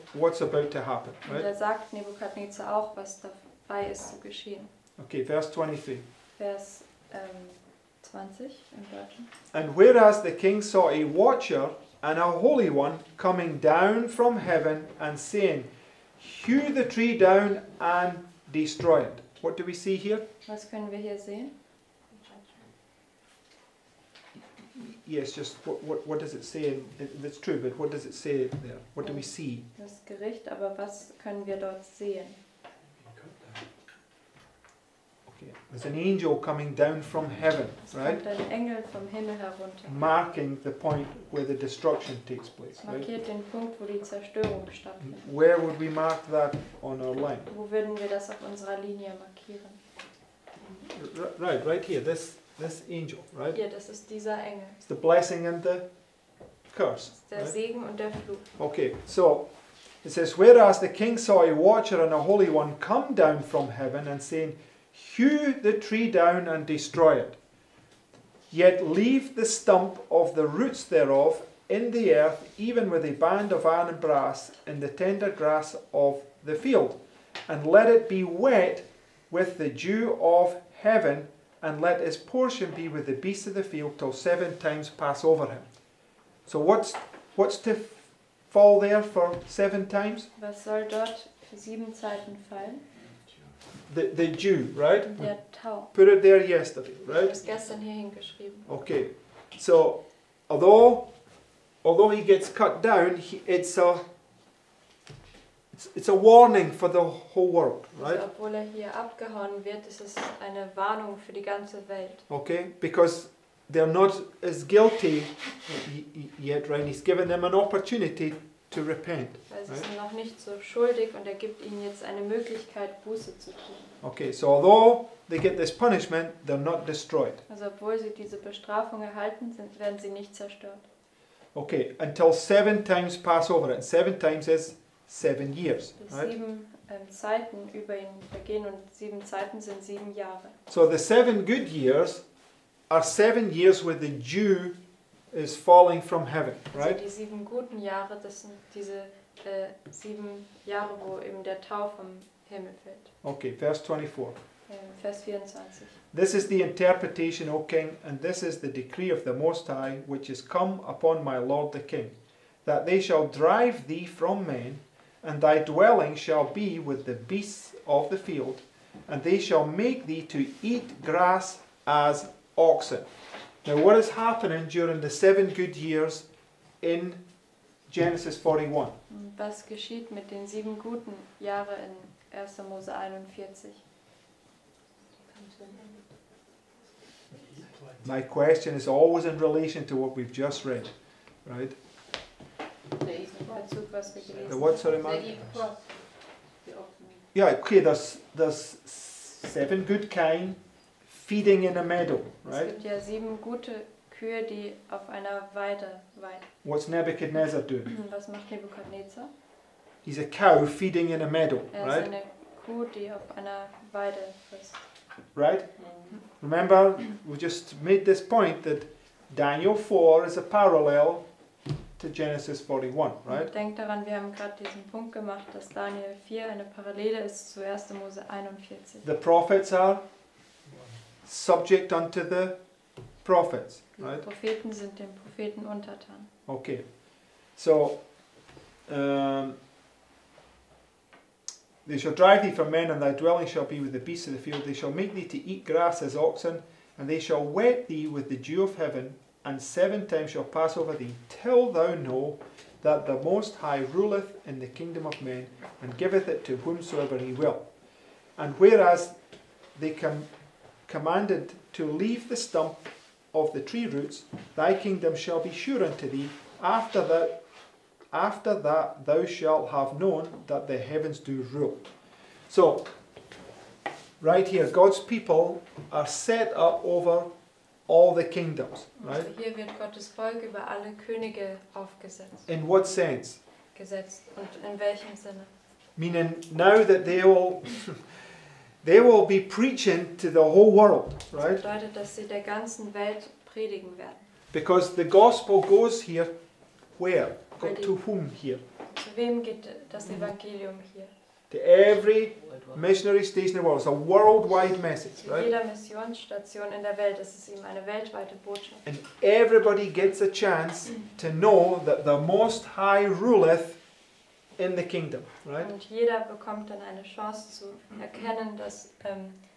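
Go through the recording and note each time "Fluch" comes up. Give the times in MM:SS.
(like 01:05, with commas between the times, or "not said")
00:58.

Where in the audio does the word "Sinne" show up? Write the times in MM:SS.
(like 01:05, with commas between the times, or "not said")
04:45.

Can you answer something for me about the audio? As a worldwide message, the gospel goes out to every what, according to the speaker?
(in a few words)
Missionary station.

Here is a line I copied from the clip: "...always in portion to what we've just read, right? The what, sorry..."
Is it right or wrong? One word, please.
wrong.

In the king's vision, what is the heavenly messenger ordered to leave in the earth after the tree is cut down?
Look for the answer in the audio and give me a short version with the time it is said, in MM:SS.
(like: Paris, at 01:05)
The stump of the roots, at 01:09.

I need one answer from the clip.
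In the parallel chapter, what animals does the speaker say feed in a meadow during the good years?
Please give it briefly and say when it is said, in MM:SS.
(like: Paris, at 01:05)
Seven good kine, at 03:18.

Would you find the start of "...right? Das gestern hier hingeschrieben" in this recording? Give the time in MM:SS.
01:37.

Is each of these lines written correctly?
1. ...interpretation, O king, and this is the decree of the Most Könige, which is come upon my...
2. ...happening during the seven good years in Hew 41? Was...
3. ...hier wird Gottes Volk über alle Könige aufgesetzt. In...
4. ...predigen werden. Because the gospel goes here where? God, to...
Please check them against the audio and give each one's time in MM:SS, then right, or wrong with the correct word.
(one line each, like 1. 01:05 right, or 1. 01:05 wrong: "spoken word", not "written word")
1. 02:36 wrong: "High", not "Könige"
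2. 02:54 wrong: "Genesis", not "Hew"
3. 04:39 right
4. 04:53 right.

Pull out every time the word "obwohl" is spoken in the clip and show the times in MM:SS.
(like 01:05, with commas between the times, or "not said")
01:48, 02:07.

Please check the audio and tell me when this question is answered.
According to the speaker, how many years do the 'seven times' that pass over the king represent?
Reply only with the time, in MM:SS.
02:13.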